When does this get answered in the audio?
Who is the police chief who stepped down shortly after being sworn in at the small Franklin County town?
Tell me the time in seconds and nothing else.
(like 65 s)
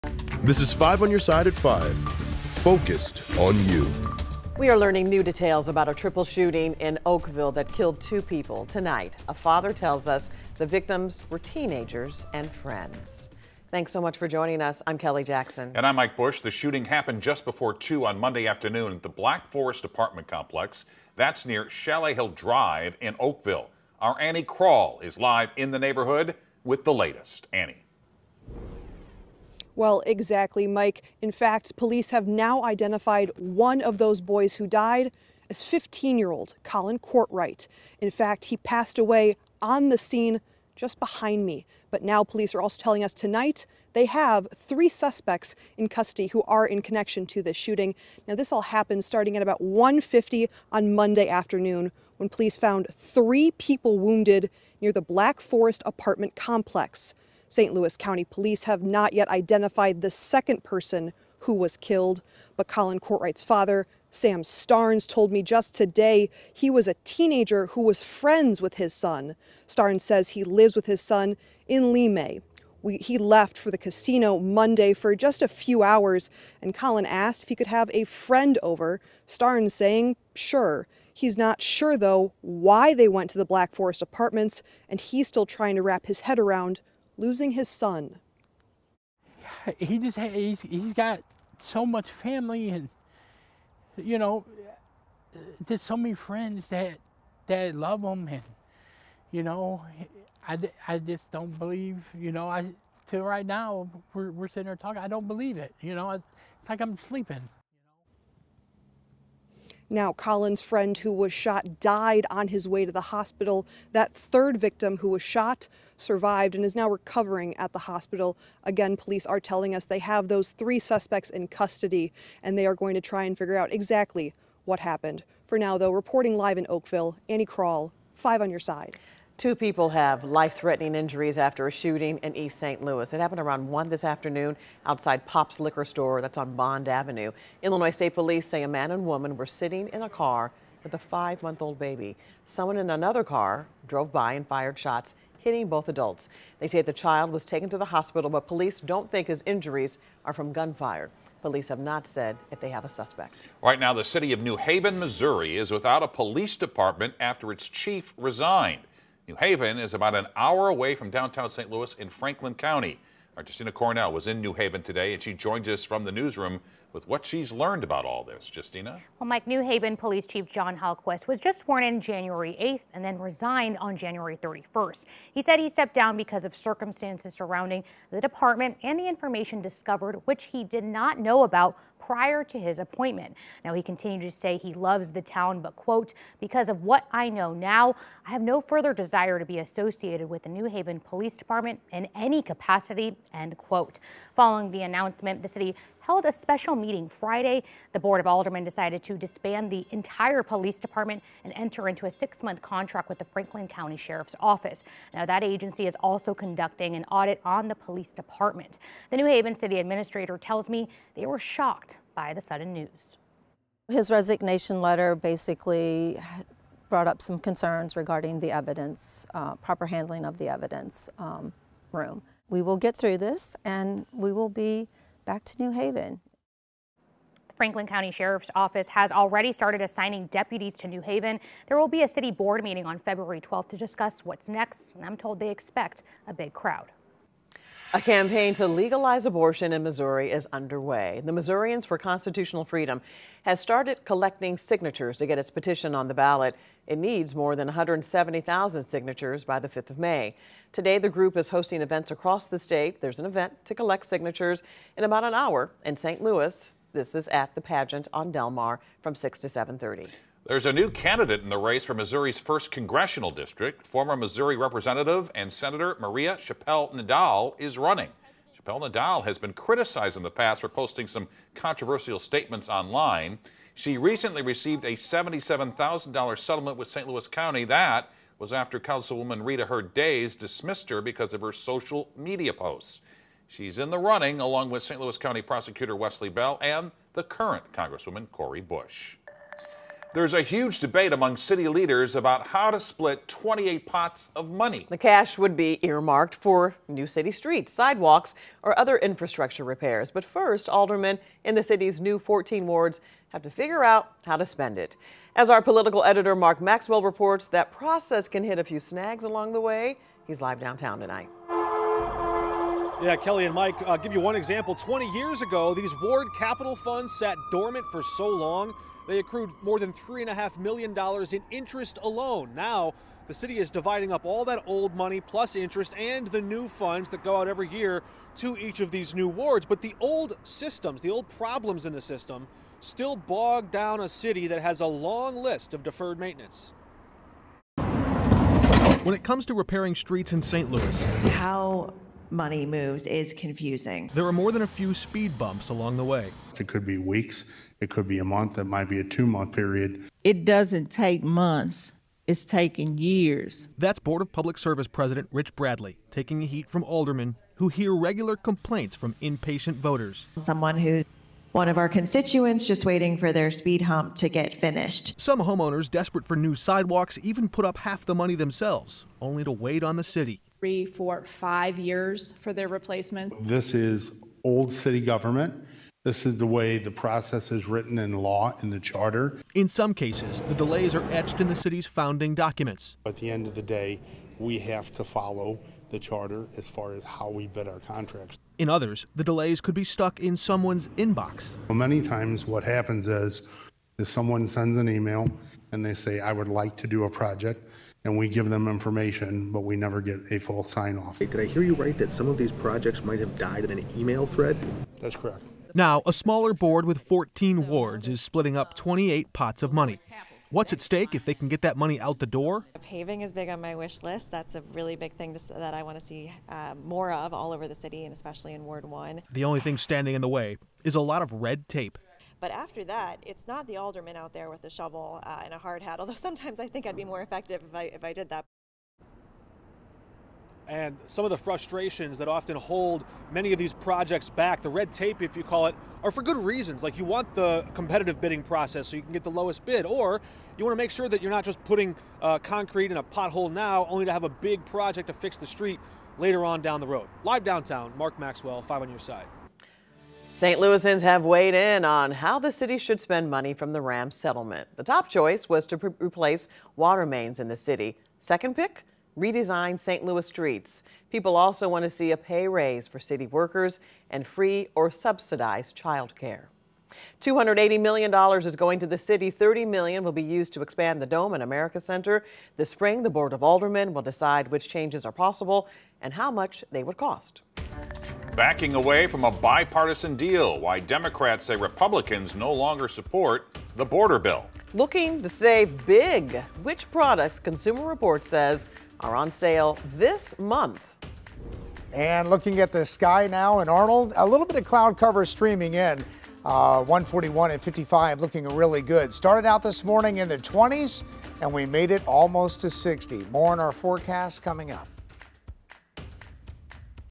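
170 s.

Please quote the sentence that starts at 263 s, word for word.
Former Missouri Representative and Senator Maria Chappelle Nadal is running.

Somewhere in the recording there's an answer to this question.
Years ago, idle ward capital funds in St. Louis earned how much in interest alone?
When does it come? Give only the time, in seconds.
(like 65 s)
319 s.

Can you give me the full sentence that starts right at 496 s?
Uh, 141 and 55 looking really good.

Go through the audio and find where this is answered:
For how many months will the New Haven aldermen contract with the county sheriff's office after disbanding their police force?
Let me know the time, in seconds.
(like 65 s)
202 s.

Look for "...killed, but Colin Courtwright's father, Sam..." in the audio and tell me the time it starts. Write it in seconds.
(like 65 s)
61 s.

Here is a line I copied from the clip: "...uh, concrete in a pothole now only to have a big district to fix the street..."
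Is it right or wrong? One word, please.
wrong.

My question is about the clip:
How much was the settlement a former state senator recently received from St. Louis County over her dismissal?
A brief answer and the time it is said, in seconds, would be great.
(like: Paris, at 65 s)
$77,000, at 274 s.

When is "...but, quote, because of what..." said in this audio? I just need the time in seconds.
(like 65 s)
185 s.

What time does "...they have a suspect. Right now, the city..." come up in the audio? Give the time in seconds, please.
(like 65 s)
152 s.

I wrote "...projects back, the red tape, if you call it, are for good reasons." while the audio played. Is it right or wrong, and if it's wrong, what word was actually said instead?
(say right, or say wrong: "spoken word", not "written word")
right.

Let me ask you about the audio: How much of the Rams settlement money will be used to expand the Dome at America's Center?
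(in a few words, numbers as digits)
$30 million.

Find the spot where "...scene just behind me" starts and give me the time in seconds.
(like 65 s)
39 s.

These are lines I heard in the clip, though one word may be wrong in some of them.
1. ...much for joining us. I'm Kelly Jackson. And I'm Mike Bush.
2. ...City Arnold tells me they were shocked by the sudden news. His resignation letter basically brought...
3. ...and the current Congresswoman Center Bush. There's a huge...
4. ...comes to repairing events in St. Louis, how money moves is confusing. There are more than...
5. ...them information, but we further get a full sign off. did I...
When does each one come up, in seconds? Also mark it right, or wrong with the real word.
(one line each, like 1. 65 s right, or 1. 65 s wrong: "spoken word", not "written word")
1. 14 s right
2. 209 s wrong: "Administrator", not "Arnold"
3. 286 s wrong: "Cori", not "Center"
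4. 339 s wrong: "streets", not "events"
5. 398 s wrong: "never", not "further".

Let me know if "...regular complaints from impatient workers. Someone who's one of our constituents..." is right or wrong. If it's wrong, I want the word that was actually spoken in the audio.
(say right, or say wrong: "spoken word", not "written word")
wrong: "voters", not "workers".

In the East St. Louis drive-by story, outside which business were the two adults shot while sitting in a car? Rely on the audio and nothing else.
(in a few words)
Pop's Liquor Store.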